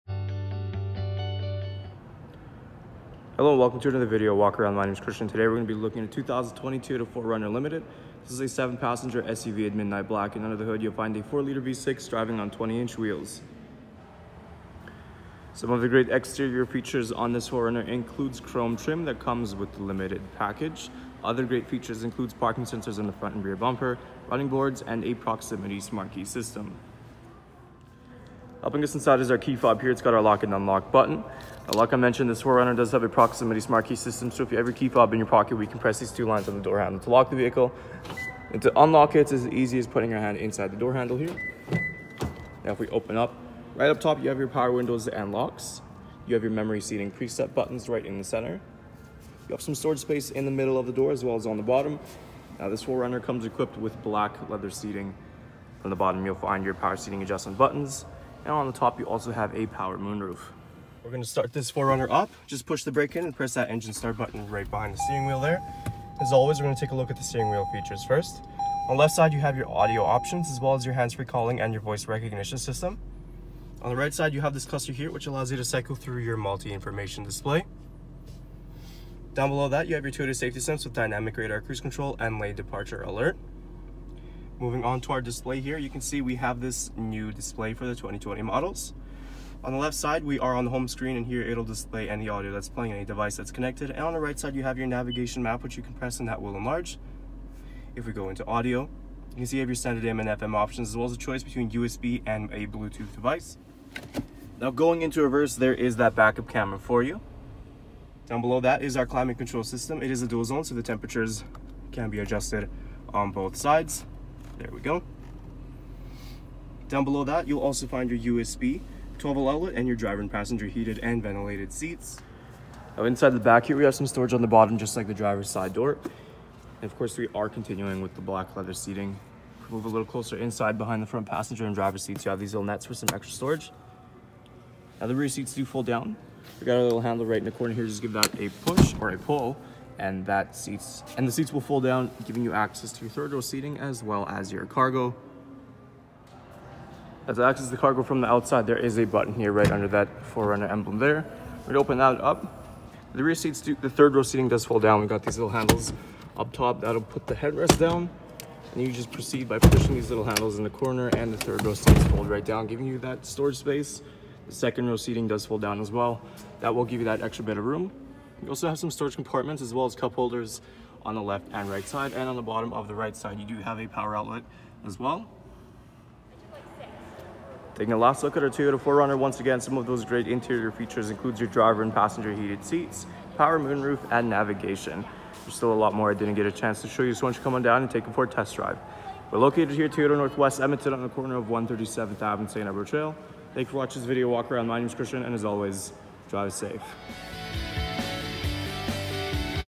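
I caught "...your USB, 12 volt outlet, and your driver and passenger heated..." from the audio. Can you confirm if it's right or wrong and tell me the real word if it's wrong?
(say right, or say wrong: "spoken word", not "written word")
right.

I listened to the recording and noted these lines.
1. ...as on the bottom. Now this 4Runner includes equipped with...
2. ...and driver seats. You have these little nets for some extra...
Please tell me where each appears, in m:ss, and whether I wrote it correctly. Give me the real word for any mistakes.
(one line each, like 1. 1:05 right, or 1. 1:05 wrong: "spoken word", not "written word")
1. 0:51 wrong: "comes", not "includes"
2. 2:11 right.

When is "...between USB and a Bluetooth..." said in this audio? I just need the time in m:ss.
1:41.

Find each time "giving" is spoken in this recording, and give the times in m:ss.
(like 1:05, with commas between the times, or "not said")
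2:22, 2:42.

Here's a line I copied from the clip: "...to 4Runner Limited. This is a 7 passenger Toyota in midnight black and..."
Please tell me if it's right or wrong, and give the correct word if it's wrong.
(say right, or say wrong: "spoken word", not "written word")
wrong: "SUV", not "Toyota".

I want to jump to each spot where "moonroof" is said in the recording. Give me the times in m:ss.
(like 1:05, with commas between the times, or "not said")
0:59, 3:03.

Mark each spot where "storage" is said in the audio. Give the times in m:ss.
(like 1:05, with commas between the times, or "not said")
0:49, 2:04, 2:13, 2:43, 2:48.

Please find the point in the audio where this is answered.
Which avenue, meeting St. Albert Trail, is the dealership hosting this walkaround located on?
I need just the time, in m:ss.
3:11.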